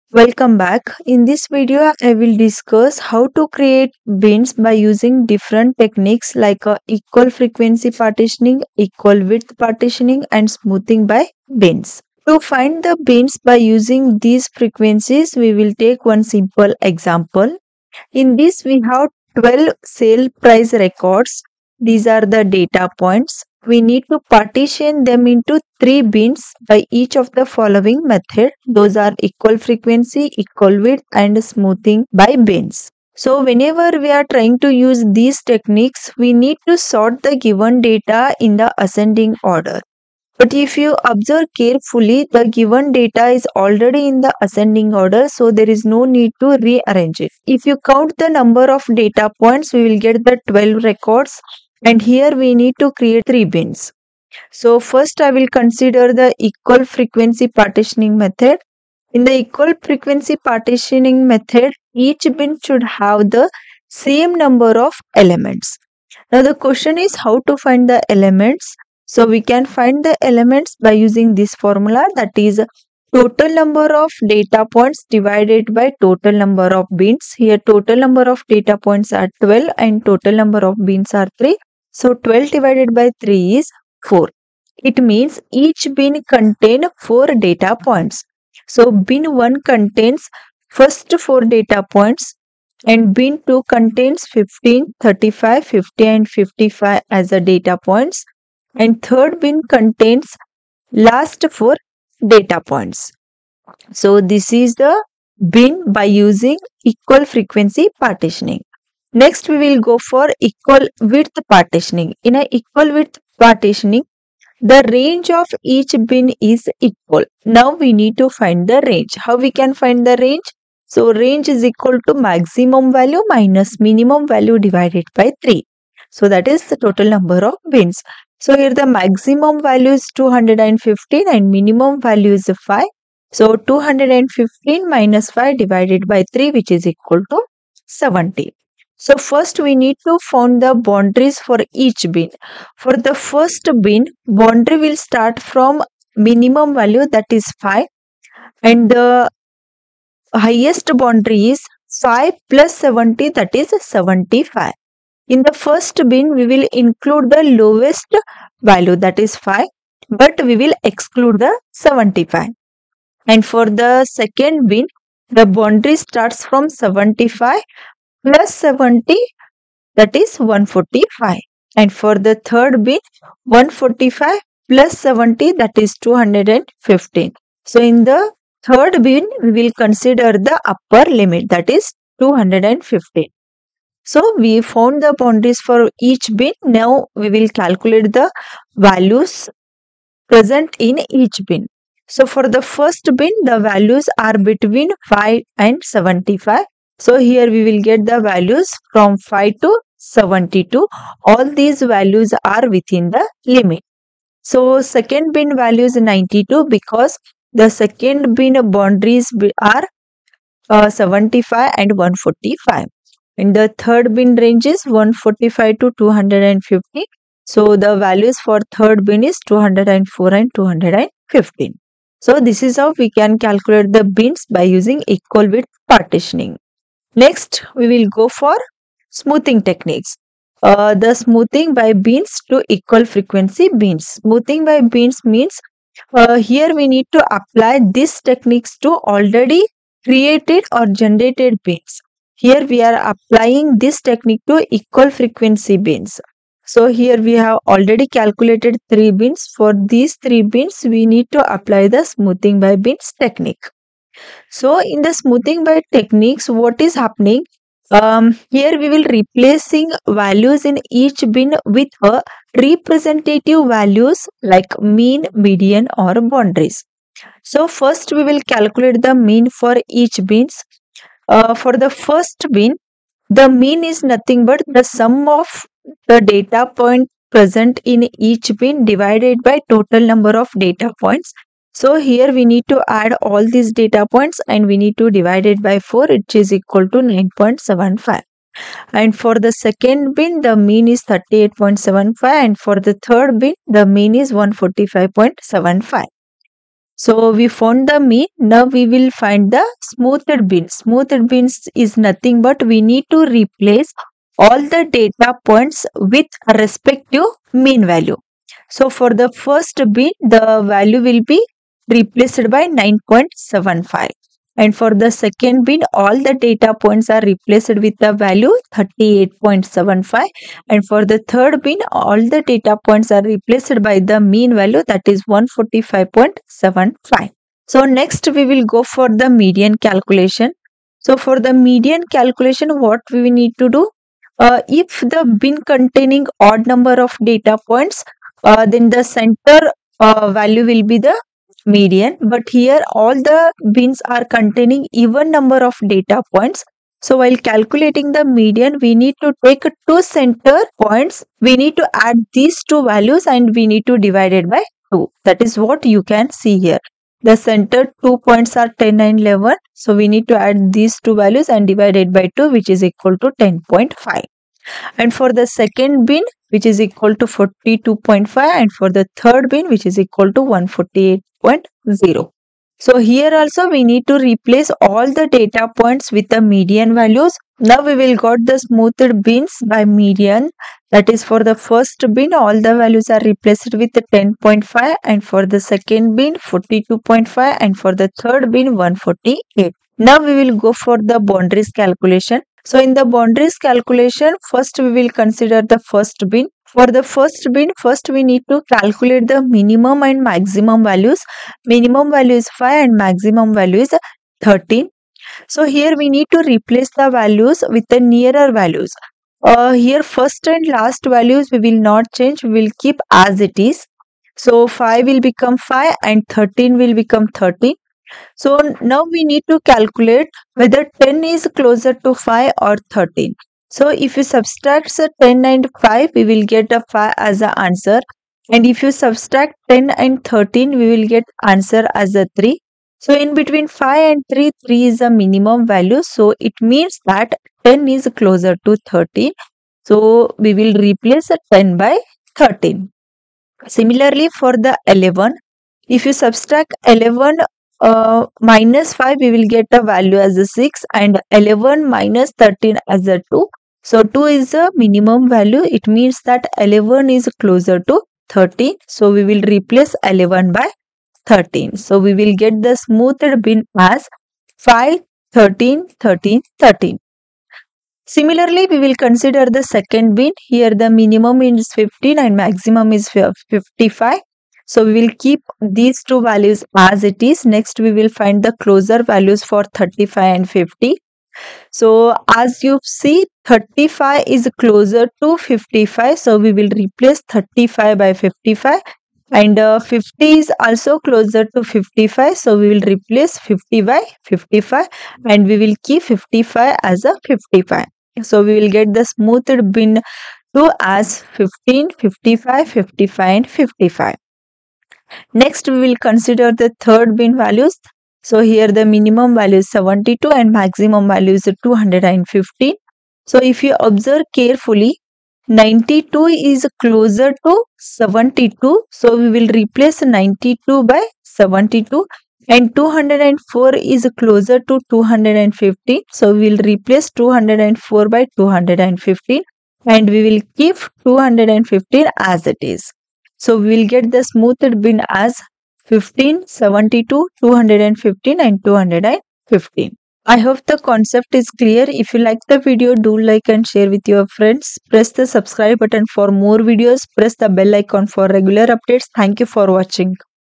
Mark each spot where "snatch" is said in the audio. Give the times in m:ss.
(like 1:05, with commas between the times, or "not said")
not said.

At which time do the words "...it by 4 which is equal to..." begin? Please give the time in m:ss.
4:45.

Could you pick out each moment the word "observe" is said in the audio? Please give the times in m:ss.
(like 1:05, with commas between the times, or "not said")
0:41, 8:33.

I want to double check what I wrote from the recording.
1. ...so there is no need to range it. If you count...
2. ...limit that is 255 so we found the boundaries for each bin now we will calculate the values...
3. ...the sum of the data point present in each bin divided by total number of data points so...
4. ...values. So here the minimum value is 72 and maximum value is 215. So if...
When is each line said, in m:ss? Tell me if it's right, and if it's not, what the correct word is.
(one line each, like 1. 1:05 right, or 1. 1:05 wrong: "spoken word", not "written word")
1. 0:45 wrong: "rearrange", not "range"
2. 3:01 wrong: "215", not "255"
3. 4:34 right
4. 8:27 right.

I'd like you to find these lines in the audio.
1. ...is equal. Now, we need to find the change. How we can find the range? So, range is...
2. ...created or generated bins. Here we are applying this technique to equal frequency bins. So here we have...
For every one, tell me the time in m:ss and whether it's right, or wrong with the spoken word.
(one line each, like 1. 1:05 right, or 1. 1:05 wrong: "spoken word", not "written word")
1. 1:56 wrong: "range", not "change"
2. 4:00 right.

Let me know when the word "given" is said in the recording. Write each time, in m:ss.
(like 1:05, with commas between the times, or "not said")
0:37, 0:42.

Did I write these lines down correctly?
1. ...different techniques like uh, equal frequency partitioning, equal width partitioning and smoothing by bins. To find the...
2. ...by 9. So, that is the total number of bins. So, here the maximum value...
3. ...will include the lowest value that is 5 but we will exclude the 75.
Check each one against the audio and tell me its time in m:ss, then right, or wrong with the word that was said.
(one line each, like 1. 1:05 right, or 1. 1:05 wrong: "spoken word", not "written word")
1. 0:05 right
2. 2:05 wrong: "3", not "9"
3. 2:36 right.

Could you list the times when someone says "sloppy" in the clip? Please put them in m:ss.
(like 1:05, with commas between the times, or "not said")
not said.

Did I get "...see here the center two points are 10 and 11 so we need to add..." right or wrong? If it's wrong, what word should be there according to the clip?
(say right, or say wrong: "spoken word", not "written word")
right.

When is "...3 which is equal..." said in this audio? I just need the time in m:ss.
2:16.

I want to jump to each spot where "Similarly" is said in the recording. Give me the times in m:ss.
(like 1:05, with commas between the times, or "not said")
7:23, 7:48.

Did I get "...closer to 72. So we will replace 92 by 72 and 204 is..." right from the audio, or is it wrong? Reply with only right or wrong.
right.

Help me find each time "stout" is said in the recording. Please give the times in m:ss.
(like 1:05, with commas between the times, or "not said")
not said.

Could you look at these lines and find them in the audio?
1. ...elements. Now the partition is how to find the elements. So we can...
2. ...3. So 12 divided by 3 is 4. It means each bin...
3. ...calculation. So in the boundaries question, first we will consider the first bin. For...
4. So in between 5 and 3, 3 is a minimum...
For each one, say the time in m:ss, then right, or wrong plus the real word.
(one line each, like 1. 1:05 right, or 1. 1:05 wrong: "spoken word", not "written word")
1. 1:05 wrong: "question", not "partition"
2. 1:21 right
3. 6:31 wrong: "calculation", not "question"
4. 7:12 right.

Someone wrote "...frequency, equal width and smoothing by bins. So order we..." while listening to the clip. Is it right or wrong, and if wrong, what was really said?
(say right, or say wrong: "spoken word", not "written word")
wrong: "whenever", not "order".